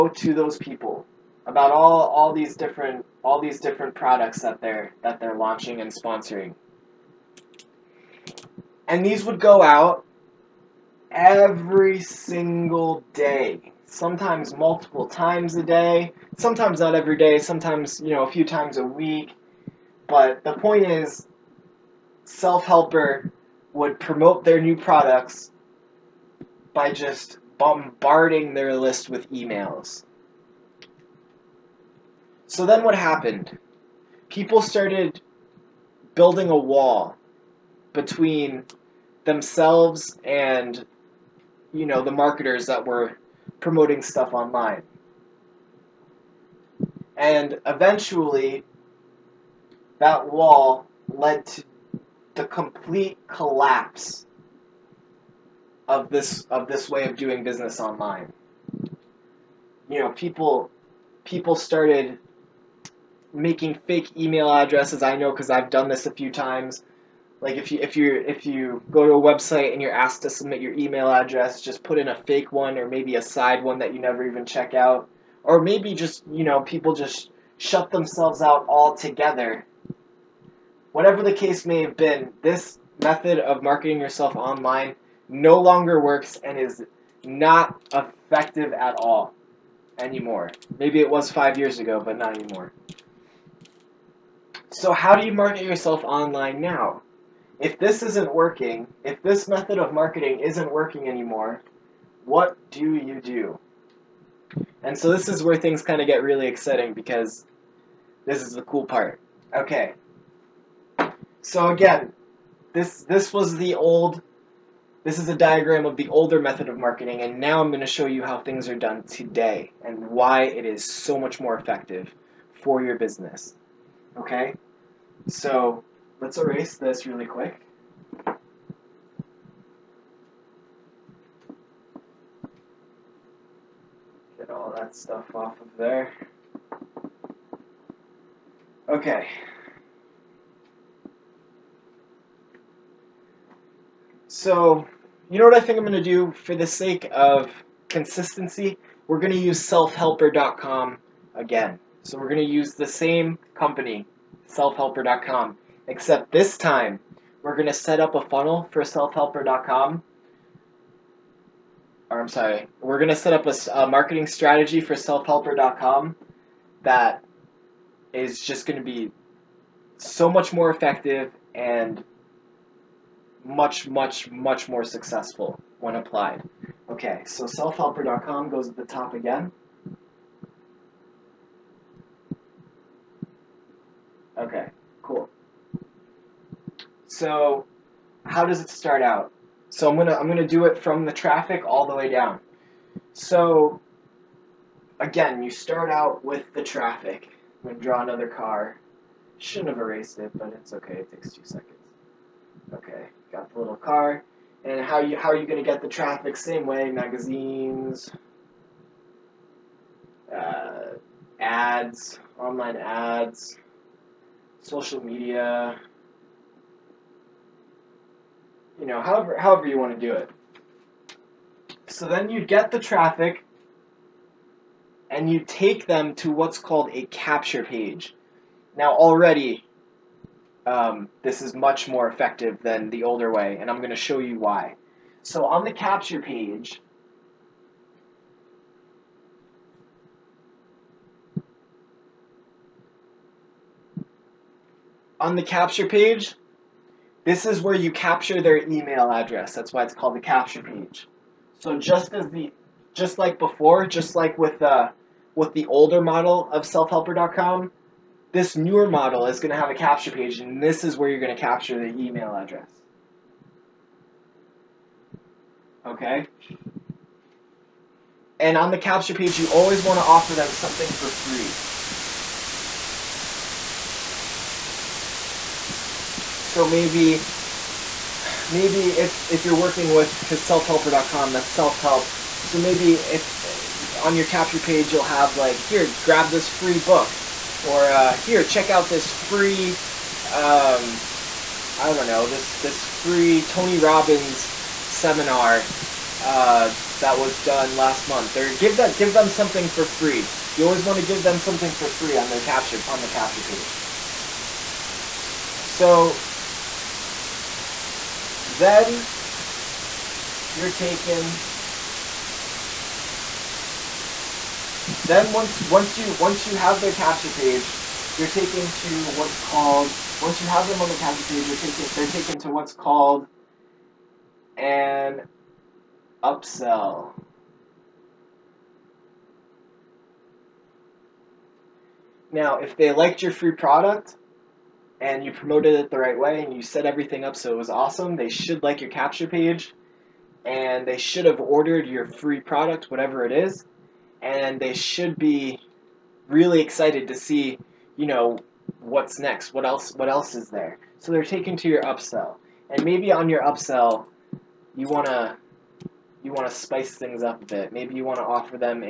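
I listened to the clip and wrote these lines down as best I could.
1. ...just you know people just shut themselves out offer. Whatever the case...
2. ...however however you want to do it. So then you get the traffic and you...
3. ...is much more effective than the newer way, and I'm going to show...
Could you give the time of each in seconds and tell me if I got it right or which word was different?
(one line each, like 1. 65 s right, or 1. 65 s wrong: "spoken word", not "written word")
1. 75 s wrong: "altogether", not "offer"
2. 219 s right
3. 231 s wrong: "older", not "newer".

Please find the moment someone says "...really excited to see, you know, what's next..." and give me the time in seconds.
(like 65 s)
346 s.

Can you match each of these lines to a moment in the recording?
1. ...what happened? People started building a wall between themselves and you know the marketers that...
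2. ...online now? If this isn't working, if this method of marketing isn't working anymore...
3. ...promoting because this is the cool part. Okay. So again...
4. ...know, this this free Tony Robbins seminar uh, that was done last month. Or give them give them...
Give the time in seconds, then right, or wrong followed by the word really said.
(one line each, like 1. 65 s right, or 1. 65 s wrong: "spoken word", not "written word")
1. 32 s right
2. 96 s right
3. 106 s wrong: "exciting", not "promoting"
4. 292 s right.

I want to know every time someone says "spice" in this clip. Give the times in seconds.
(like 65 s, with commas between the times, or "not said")
356 s.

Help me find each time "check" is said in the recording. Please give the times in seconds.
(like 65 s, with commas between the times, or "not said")
74 s, 288 s.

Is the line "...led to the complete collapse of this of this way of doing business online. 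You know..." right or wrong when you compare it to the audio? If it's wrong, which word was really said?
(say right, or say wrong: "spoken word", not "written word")
right.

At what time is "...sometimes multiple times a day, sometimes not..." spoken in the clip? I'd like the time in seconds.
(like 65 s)
13 s.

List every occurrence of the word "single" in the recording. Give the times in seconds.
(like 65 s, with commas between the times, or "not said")
11 s.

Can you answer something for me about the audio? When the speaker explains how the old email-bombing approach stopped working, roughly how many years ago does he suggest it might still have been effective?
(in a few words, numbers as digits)
5.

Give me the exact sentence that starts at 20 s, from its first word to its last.
But the point is self-helper would promote their new products by just bombarding their list with emails.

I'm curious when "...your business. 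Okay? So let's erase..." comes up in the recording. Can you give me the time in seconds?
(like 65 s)
122 s.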